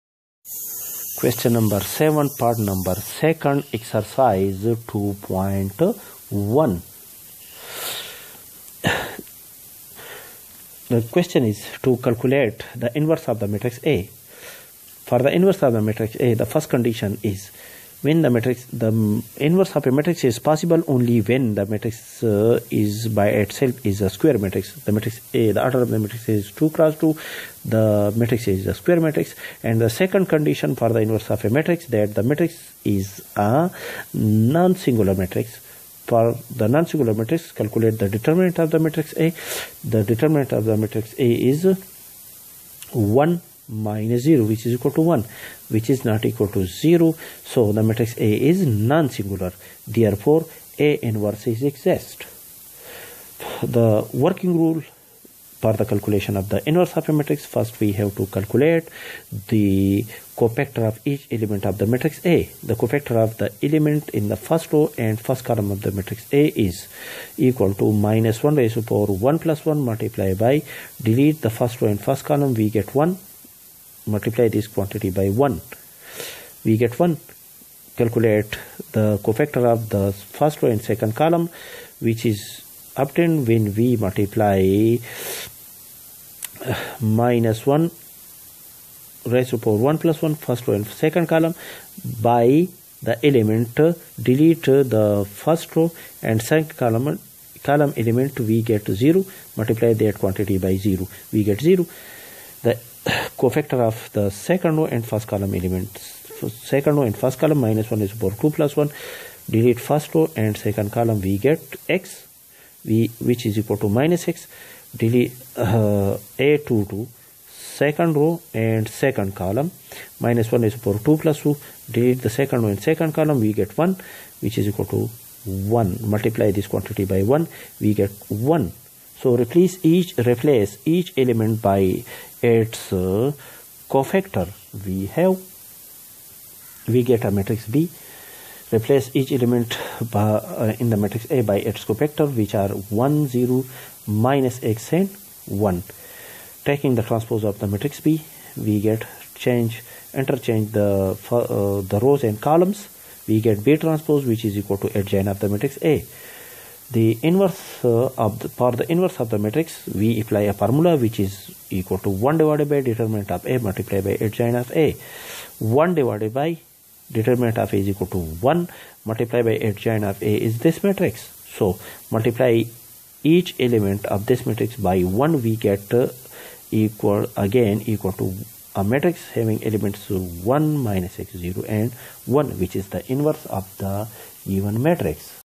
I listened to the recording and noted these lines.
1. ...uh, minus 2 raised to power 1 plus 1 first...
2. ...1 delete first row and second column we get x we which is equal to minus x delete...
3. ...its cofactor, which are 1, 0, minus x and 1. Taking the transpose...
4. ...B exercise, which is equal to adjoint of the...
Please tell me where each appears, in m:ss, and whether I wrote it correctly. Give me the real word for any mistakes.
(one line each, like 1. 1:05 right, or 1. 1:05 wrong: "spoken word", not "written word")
1. 1:26 wrong: "1", not "2"
2. 1:48 right
3. 2:21 right
4. 2:33 wrong: "transpose", not "exercise".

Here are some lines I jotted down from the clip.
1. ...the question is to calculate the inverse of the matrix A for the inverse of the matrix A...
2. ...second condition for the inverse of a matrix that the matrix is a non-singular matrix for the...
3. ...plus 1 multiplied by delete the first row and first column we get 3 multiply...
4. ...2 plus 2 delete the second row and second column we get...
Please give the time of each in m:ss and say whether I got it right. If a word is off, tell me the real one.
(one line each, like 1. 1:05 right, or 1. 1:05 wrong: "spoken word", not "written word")
1. 0:10 right
2. 0:29 right
3. 1:09 wrong: "1", not "3"
4. 2:01 right.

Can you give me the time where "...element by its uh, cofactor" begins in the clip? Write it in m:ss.
2:11.